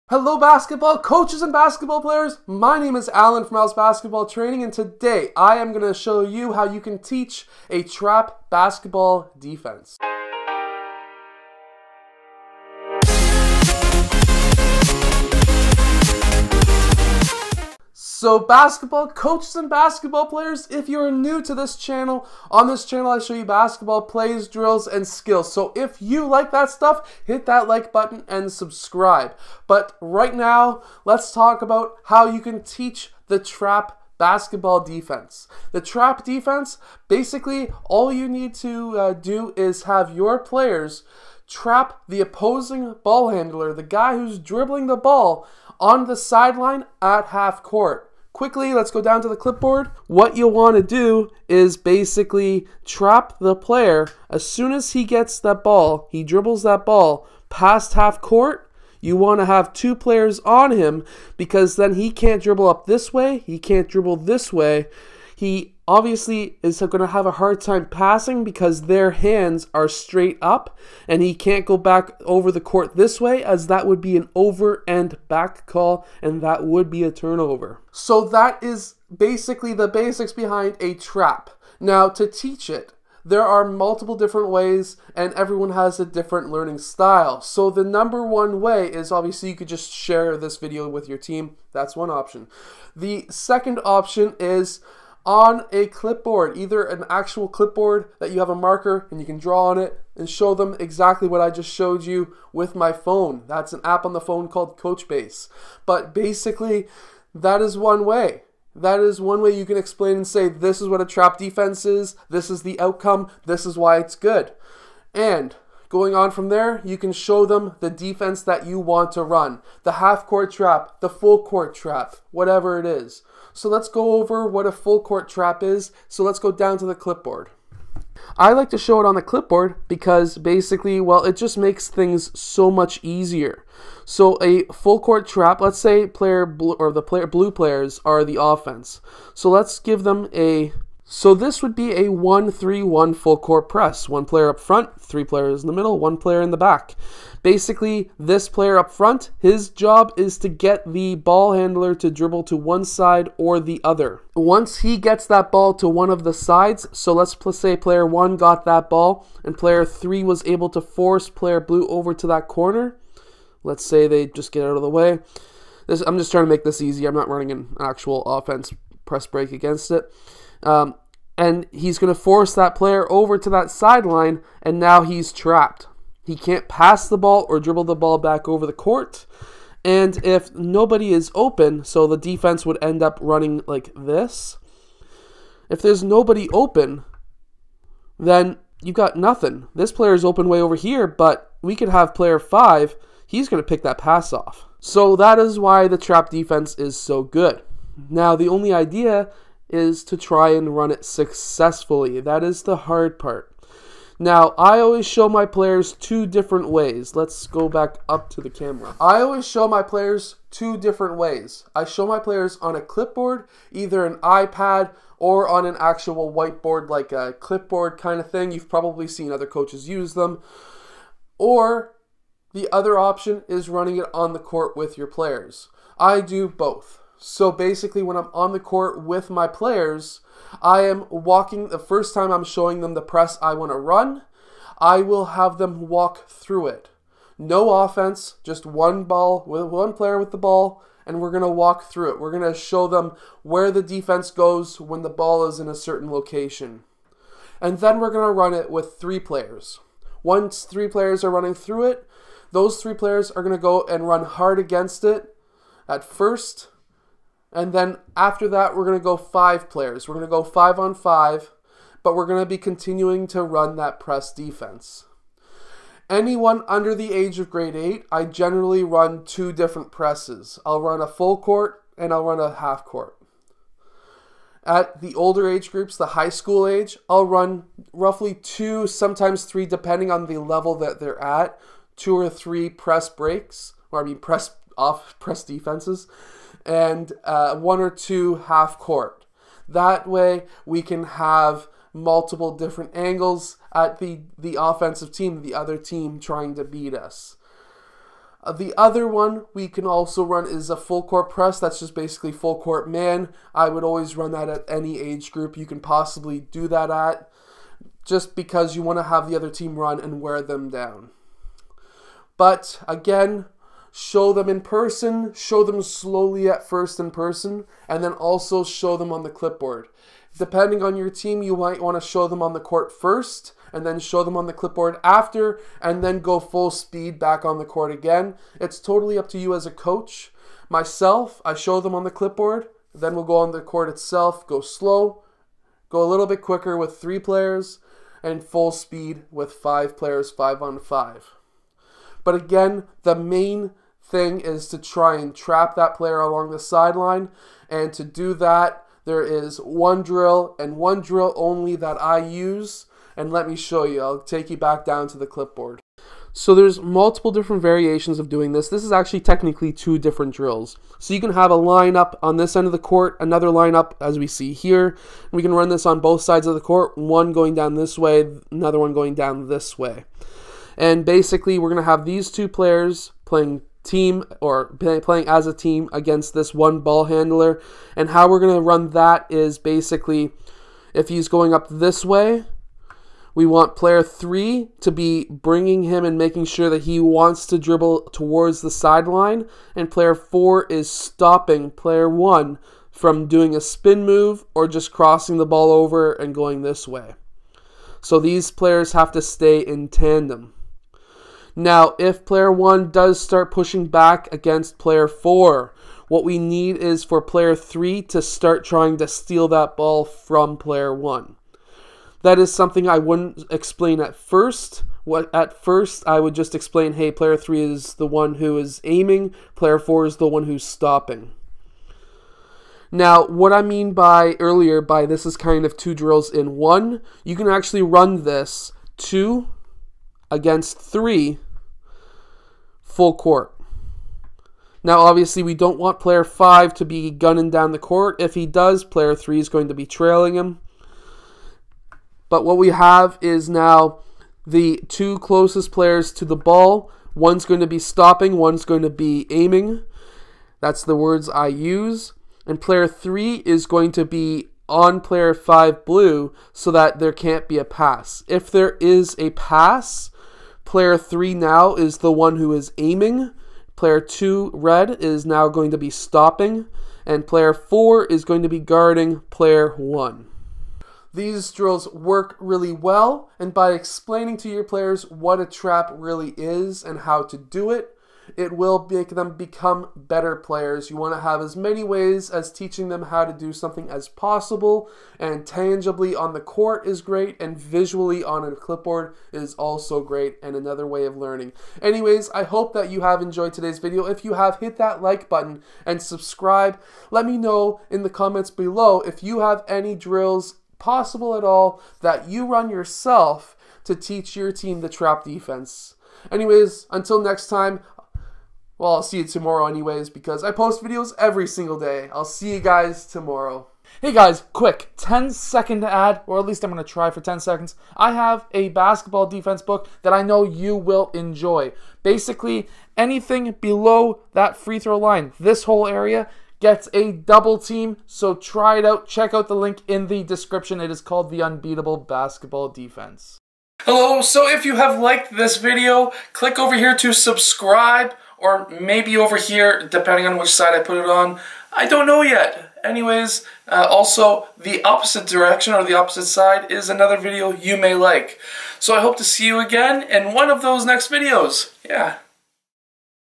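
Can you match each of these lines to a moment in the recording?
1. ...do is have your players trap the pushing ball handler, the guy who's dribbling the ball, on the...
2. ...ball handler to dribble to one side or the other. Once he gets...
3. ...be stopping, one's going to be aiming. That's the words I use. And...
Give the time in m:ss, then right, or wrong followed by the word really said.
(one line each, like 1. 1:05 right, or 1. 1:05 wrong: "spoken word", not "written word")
1. 0:39 wrong: "opposing", not "pushing"
2. 2:31 right
3. 7:27 right.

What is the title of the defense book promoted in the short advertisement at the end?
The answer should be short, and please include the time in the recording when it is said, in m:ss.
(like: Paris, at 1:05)
The Unbeatable Basketball Defense, at 8:51.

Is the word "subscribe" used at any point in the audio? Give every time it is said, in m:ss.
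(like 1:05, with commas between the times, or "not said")
0:28, 8:16, 8:57.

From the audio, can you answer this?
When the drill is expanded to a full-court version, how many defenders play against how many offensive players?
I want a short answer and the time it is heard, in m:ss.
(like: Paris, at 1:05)
two against three, at 7:08.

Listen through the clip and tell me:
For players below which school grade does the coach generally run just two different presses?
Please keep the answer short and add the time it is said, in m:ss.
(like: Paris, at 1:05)
grade 8, at 4:27.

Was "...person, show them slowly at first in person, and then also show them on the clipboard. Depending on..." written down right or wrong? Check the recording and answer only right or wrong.
right.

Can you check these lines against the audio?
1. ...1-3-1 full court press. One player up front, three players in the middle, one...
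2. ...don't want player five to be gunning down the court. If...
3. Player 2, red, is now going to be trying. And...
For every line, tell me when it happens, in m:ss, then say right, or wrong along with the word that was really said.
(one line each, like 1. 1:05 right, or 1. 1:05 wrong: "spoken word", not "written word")
1. 2:22 right
2. 7:15 right
3. 7:43 wrong: "stopping", not "trying".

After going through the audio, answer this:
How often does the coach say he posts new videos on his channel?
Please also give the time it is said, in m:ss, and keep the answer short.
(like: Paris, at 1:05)
every single day, at 8:31.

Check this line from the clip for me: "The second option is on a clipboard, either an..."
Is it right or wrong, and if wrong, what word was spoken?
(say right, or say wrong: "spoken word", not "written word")
right.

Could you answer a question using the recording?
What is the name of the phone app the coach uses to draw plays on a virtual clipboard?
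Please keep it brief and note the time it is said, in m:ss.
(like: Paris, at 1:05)
Coachbase, at 1:44.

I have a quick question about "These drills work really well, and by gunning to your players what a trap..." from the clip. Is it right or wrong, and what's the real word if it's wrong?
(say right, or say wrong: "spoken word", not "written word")
wrong: "explaining", not "gunning".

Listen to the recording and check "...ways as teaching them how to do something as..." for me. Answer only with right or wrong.
right.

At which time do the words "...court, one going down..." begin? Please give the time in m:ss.
6:06.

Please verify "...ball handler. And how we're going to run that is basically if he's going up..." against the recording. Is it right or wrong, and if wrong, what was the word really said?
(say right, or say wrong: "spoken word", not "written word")
right.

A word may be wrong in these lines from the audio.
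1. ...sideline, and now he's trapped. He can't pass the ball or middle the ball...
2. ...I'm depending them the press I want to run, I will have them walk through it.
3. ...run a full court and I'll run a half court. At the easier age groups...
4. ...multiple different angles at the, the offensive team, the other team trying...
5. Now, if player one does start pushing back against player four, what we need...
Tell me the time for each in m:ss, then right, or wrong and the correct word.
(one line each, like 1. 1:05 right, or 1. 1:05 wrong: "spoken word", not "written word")
1. 2:53 wrong: "dribble", not "middle"
2. 3:52 wrong: "showing", not "depending"
3. 4:30 wrong: "older", not "easier"
4. 4:51 right
5. 6:41 right.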